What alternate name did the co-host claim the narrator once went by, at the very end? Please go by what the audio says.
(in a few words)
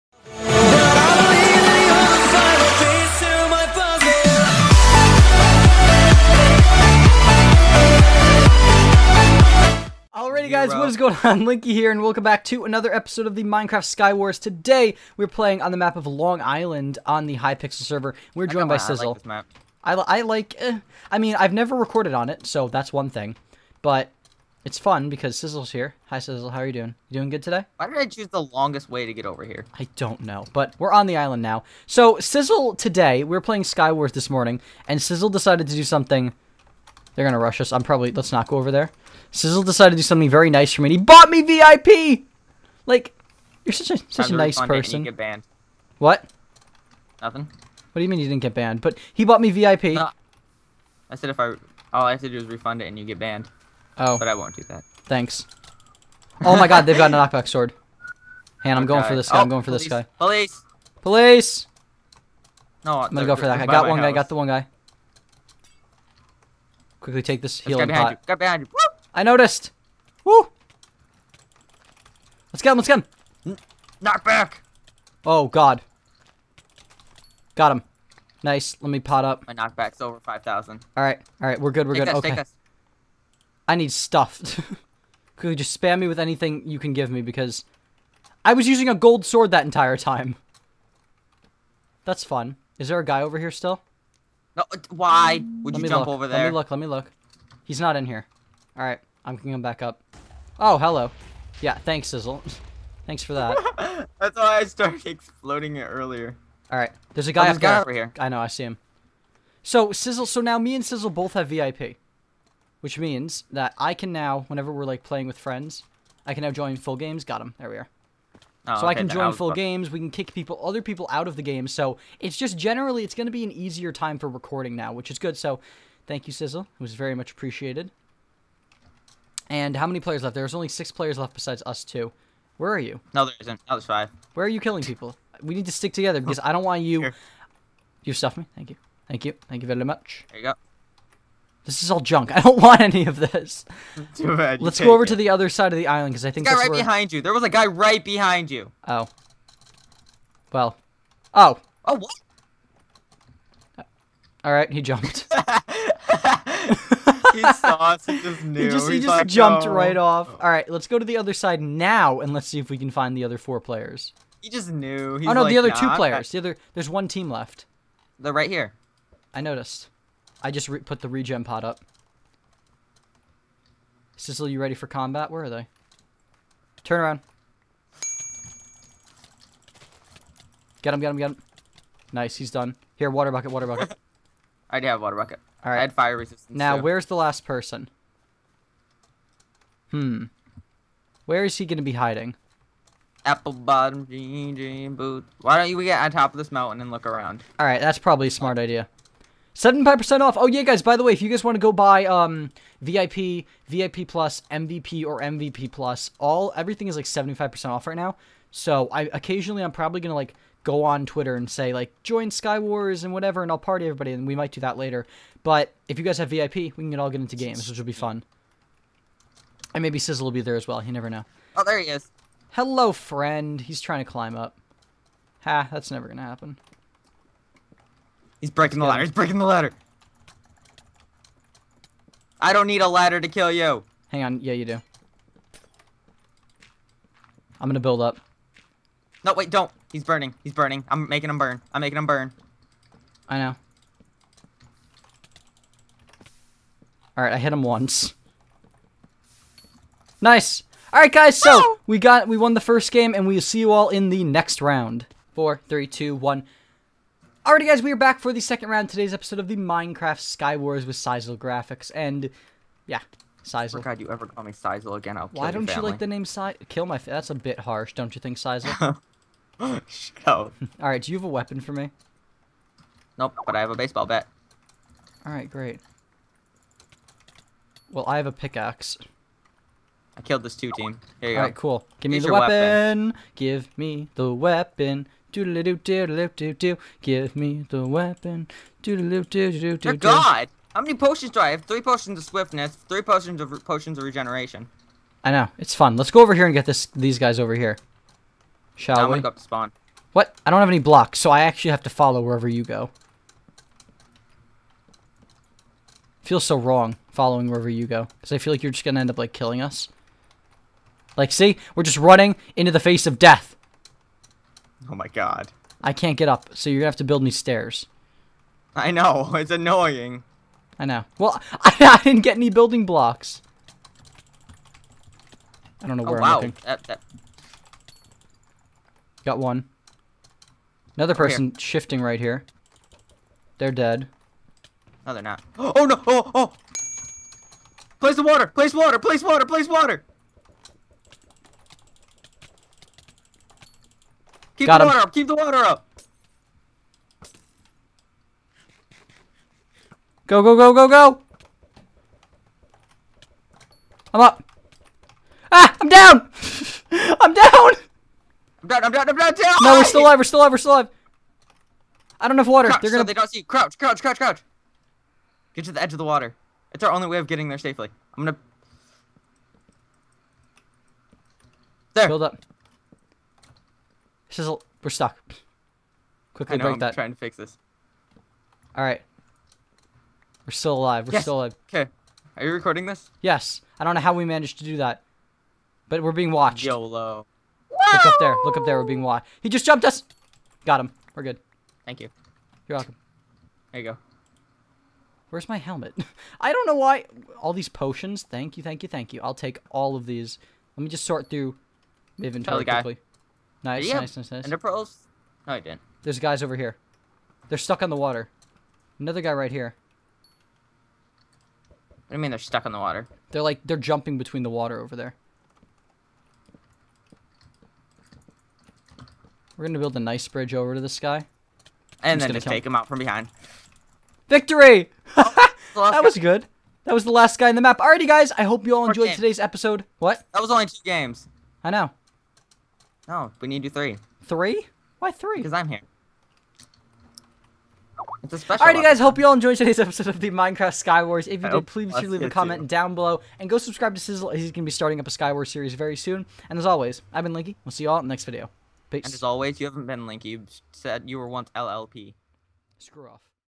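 LLP.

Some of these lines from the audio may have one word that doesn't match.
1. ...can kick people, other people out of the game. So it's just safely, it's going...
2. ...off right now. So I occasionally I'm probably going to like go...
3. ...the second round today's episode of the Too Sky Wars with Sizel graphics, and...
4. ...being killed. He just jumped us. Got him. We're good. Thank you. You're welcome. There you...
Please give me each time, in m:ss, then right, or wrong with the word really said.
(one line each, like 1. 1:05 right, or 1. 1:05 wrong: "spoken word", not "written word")
1. 1:59 wrong: "generally", not "safely"
2. 3:27 right
3. 4:18 wrong: "Minecraft", not "Too"
4. 6:28 wrong: "watched", not "killed".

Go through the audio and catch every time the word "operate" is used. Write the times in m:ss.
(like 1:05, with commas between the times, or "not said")
not said.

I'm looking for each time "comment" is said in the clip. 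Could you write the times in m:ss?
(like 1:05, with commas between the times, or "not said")
7:22.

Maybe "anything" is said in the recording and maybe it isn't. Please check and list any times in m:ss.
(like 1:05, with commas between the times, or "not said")
1:26.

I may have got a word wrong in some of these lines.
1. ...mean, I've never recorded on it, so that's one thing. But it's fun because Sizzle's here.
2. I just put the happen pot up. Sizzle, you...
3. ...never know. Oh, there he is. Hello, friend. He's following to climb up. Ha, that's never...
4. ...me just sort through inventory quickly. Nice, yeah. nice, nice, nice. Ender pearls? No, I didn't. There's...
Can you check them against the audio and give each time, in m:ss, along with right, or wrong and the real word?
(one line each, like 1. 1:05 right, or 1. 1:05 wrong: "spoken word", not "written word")
1. 0:21 right
2. 2:50 wrong: "regen", not "happen"
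3. 3:40 wrong: "trying", not "following"
4. 6:40 right.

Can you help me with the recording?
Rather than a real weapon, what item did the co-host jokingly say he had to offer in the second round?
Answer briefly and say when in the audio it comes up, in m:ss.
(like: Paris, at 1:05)
baseball bat, at 4:33.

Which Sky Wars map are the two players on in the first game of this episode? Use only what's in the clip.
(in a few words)
Long Island.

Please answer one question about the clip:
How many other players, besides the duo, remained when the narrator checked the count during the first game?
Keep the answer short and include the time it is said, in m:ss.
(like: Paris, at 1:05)
6, at 2:10.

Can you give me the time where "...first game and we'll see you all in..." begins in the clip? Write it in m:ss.
4:12.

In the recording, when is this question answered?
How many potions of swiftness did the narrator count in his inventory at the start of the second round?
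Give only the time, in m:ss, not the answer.
4:51.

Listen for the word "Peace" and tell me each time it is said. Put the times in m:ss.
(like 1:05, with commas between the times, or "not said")
7:28.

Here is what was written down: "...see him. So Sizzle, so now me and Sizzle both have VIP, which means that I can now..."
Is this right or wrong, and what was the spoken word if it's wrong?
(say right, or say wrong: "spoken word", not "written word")
right.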